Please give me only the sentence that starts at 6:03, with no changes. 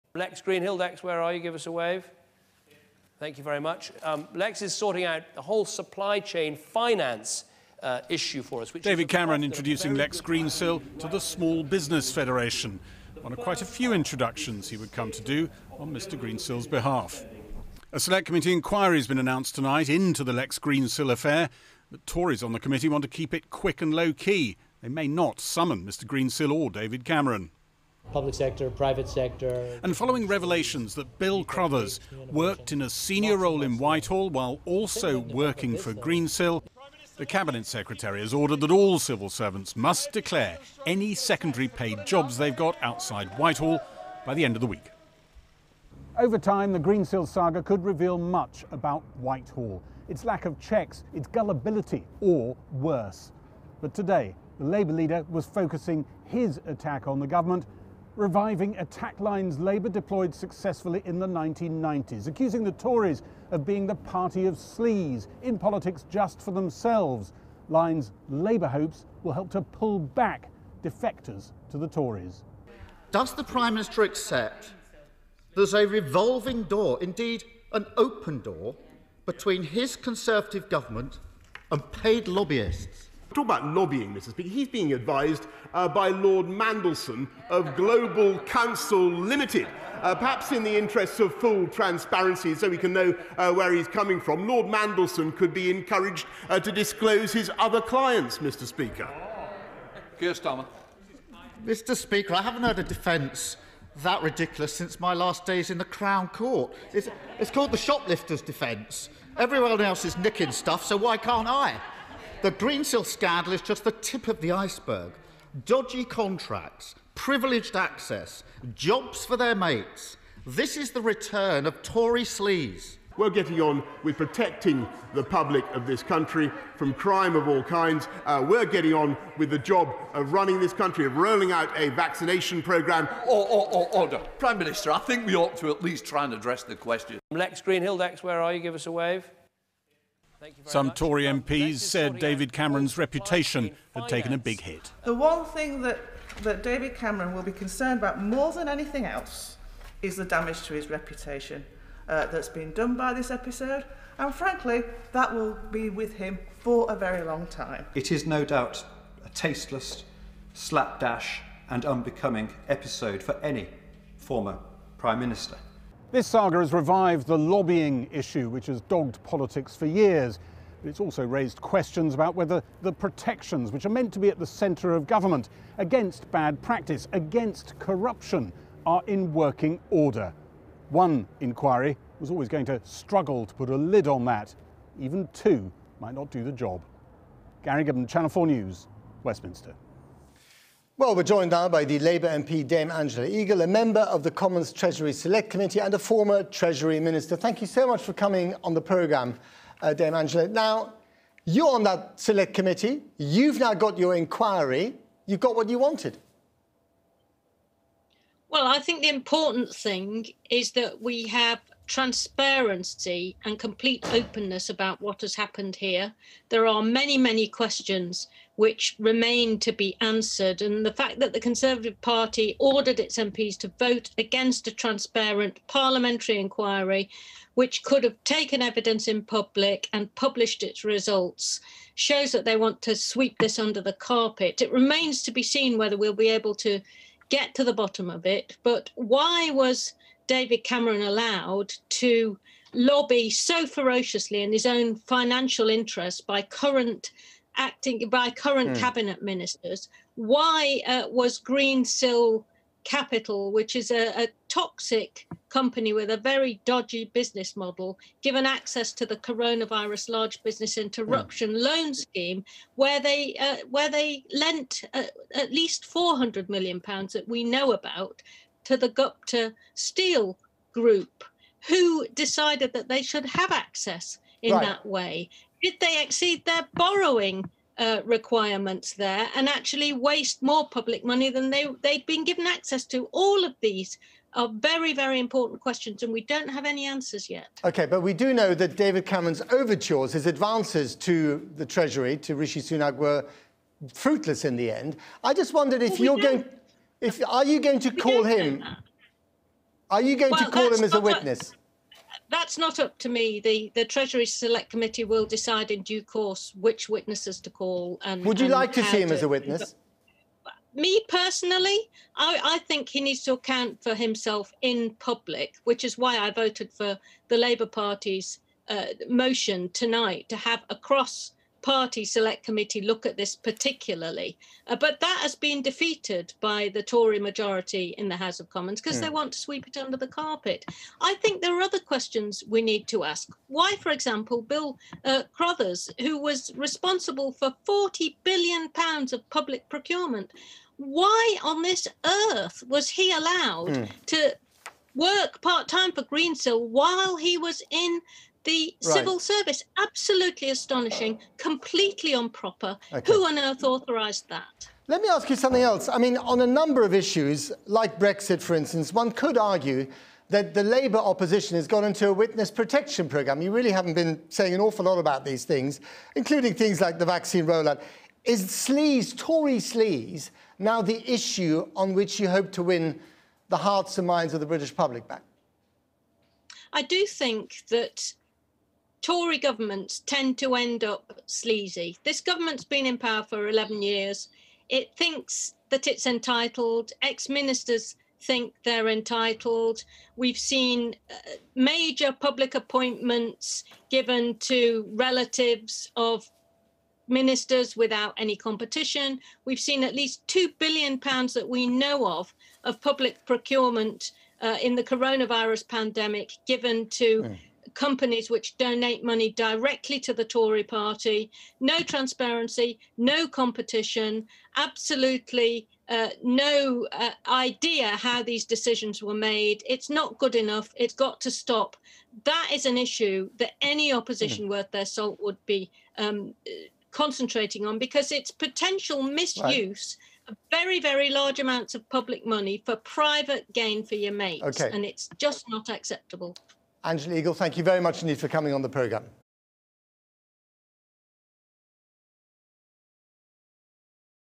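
You really haven't been saying an awful lot about these things, including things like the vaccine rollout.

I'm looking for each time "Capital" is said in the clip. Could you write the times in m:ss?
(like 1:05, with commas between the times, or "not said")
4:12.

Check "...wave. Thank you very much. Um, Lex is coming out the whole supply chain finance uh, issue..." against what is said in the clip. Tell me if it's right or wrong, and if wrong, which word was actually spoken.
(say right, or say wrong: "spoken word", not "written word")
wrong: "sorting", not "coming".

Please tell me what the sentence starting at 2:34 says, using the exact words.
And frankly, that will be with him for a very long time.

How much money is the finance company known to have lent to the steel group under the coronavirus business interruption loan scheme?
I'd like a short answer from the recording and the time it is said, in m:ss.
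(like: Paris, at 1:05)
£400 million, at 4:25.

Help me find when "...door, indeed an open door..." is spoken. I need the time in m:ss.
1:16.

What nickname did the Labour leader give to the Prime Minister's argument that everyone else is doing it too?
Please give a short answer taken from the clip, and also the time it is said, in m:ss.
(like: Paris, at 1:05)
shoplifter's defence, at 1:47.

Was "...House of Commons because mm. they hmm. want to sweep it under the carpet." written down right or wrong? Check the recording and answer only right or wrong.
right.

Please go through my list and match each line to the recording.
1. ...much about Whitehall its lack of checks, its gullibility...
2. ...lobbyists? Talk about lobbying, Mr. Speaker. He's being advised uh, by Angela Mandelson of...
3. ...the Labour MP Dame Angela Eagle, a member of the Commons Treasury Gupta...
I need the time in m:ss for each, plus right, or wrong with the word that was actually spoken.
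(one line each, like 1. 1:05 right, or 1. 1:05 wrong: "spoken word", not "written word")
1. 0:48 right
2. 1:22 wrong: "Lord", not "Angela"
3. 3:11 wrong: "Select", not "Gupta".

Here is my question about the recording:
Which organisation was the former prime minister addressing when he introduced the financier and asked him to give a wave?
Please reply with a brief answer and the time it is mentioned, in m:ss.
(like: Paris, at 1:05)
Small Business Federation, at 0:11.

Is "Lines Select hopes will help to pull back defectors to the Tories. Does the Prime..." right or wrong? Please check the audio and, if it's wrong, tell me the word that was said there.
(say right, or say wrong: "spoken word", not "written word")
wrong: "Labour", not "Select".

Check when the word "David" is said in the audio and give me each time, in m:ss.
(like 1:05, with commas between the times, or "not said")
0:08, 0:26, 2:22, 2:26, 4:00, 4:48.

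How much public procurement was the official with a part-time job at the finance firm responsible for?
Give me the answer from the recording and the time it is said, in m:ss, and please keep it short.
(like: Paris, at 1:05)
£40 billion, at 5:37.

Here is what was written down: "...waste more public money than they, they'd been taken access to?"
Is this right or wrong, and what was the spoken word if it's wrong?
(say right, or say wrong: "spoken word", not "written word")
wrong: "given", not "taken".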